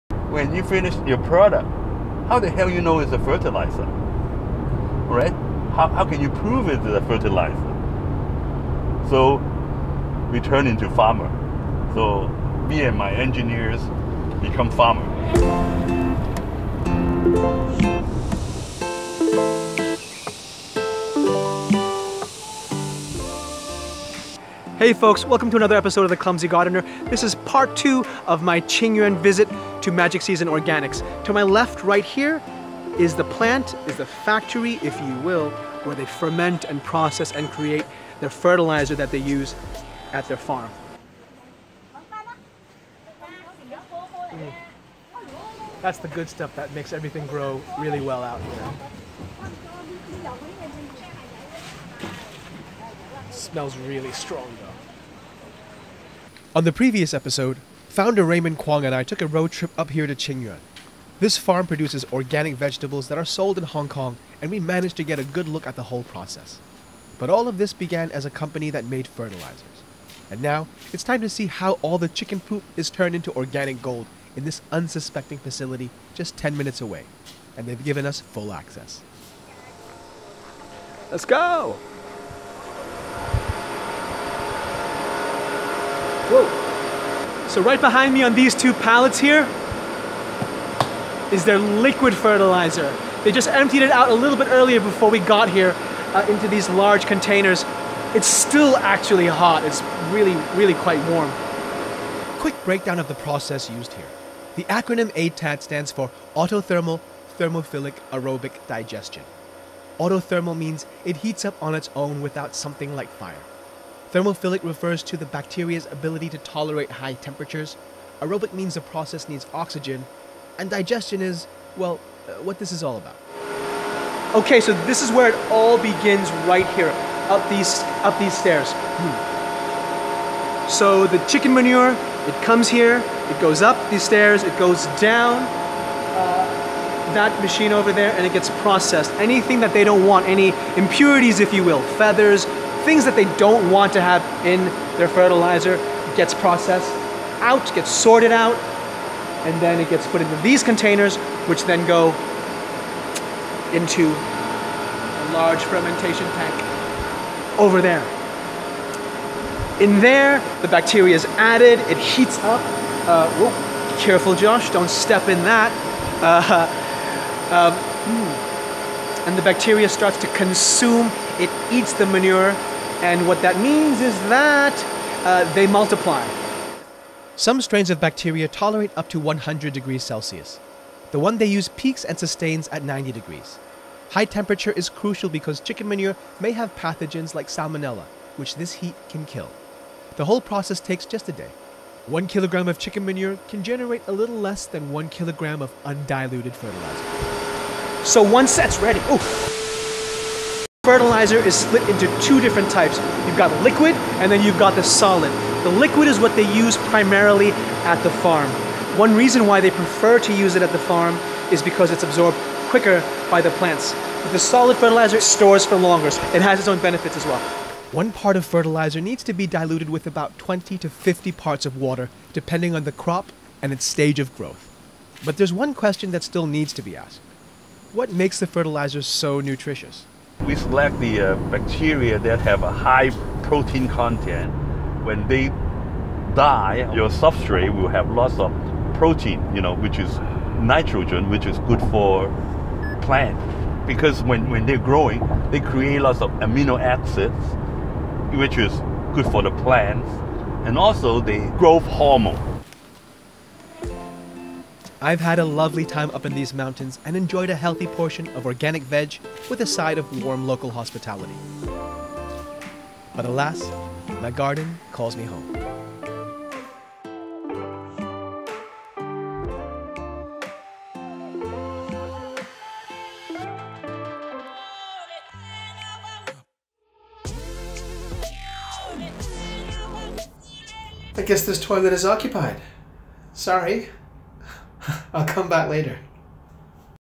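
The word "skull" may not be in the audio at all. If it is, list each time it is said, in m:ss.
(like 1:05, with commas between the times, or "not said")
not said.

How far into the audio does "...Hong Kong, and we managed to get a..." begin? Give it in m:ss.
1:03.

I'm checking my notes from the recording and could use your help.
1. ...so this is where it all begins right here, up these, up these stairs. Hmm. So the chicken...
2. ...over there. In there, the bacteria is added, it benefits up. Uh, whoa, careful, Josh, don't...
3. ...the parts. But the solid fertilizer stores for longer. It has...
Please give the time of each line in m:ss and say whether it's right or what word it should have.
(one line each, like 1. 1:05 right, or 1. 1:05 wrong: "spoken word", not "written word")
1. 2:04 right
2. 2:37 wrong: "heats", not "benefits"
3. 3:33 wrong: "plants", not "parts".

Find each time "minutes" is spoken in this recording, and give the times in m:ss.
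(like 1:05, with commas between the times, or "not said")
1:16.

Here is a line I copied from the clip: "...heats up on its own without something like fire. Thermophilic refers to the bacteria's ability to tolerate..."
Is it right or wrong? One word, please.
right.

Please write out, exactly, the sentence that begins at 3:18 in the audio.
So once that's ready, oh, fertilizer is split into two different types.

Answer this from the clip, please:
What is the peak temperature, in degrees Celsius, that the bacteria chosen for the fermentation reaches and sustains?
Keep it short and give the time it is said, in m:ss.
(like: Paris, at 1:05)
90, at 3:02.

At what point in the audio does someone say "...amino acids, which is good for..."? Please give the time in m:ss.
4:06.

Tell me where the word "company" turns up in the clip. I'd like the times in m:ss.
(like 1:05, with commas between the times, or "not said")
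1:08.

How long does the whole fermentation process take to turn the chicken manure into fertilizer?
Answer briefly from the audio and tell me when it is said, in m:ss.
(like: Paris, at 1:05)
a day, at 3:11.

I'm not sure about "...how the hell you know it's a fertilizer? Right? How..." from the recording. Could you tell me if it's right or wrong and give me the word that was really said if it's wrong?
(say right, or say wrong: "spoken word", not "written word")
right.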